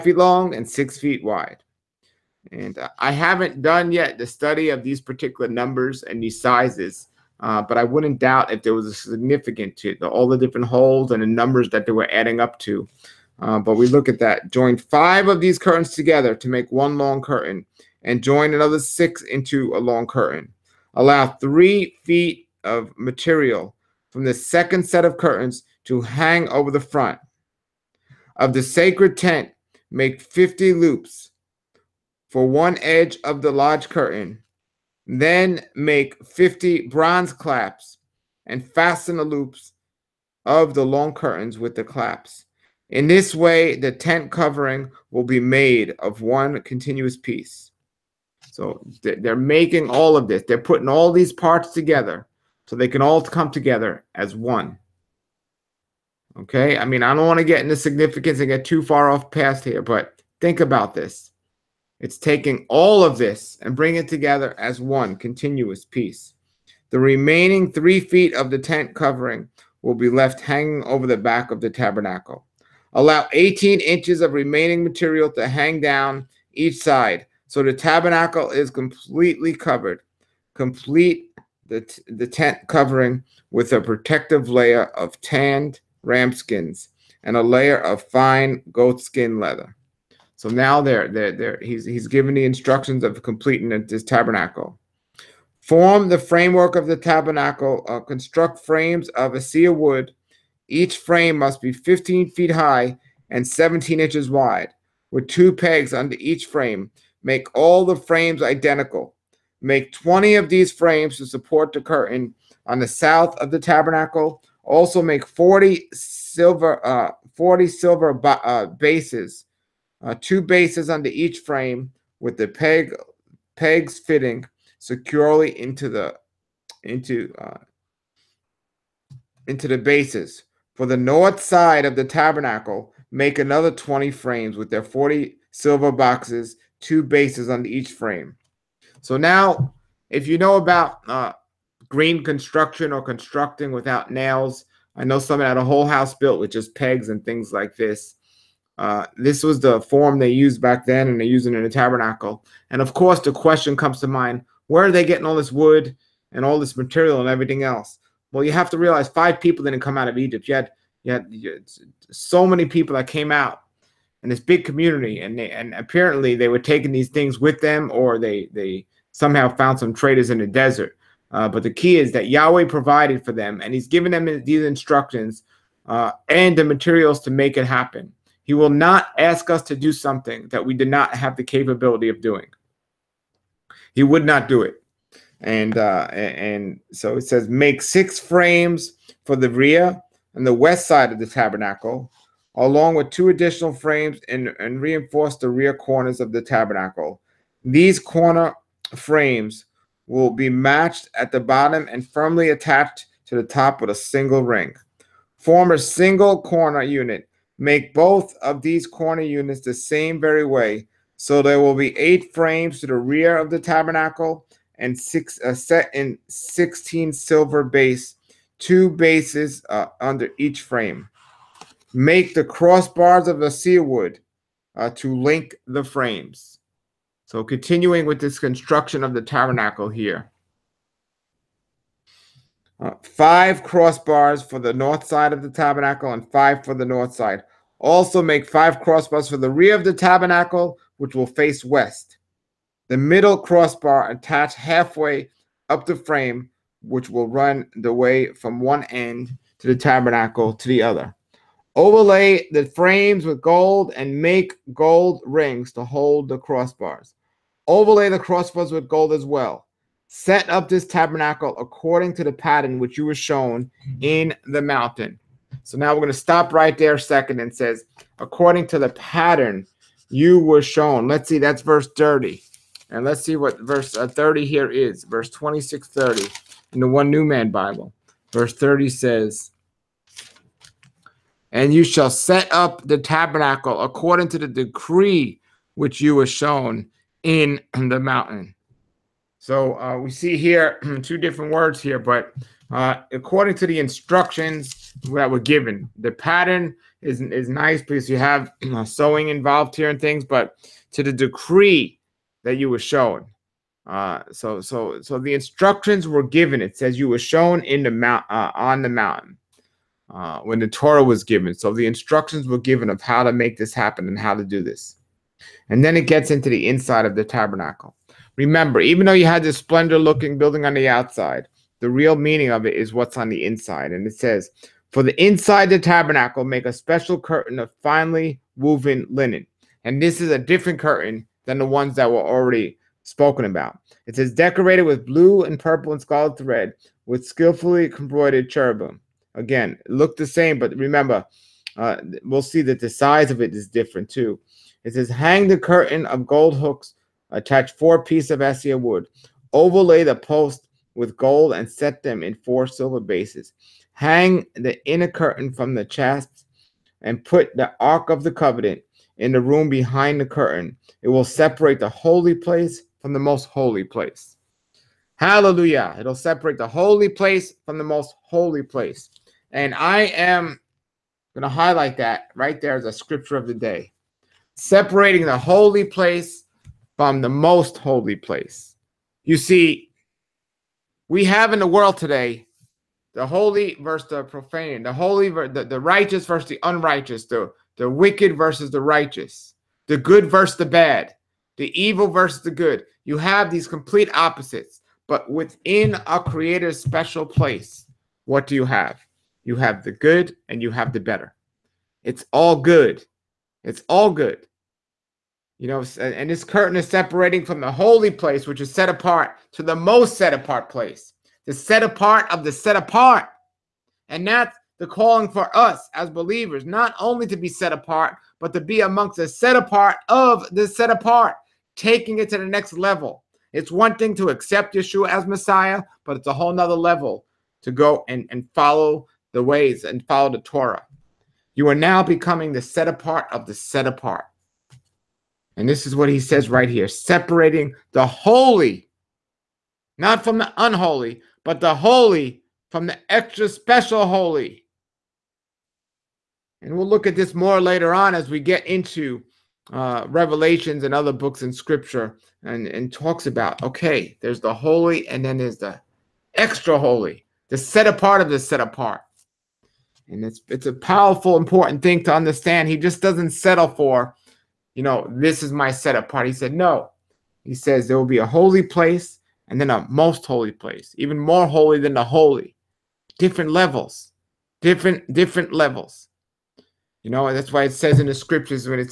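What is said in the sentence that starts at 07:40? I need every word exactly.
And it's, it's a powerful, important thing to understand.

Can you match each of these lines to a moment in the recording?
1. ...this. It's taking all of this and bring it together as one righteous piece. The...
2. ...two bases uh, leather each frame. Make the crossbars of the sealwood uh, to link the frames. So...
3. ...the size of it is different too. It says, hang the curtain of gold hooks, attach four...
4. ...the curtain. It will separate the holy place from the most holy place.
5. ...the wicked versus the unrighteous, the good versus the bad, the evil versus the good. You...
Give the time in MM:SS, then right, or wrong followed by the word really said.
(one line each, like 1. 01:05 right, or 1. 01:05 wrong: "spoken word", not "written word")
1. 01:00 wrong: "continuous", not "righteous"
2. 03:38 wrong: "under", not "leather"
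3. 05:42 right
4. 06:00 right
5. 06:27 wrong: "righteous", not "unrighteous".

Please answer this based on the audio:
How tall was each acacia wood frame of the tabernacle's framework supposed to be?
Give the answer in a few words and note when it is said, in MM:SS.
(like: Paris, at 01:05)
15 feet, at 01:41.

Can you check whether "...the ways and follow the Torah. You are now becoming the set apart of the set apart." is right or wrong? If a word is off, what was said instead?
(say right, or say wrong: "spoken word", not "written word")
right.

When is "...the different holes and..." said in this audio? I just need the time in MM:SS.
00:10.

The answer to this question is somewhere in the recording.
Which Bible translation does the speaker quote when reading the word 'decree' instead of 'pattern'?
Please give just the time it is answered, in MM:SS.
04:36.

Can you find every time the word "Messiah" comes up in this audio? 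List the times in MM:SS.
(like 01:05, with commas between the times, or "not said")
07:05.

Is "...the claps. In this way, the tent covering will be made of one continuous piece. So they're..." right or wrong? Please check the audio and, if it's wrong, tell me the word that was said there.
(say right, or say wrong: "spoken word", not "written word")
right.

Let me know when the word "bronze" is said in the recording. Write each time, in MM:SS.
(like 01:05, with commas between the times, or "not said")
00:36.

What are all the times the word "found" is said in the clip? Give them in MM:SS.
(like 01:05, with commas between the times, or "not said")
02:49.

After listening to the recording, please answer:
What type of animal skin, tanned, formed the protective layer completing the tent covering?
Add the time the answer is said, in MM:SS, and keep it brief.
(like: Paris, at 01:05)
ram skins, at 01:25.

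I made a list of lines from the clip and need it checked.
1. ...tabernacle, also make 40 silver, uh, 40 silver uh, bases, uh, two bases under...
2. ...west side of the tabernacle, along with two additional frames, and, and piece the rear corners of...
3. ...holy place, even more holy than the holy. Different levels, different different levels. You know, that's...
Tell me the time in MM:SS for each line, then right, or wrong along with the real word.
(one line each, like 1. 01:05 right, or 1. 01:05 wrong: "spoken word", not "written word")
1. 01:53 right
2. 03:10 wrong: "reinforce", not "piece"
3. 07:50 right.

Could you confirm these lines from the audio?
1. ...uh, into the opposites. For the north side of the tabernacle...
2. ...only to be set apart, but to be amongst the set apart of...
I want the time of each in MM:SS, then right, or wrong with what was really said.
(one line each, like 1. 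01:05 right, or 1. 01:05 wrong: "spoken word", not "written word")
1. 02:07 wrong: "bases", not "opposites"
2. 06:56 right.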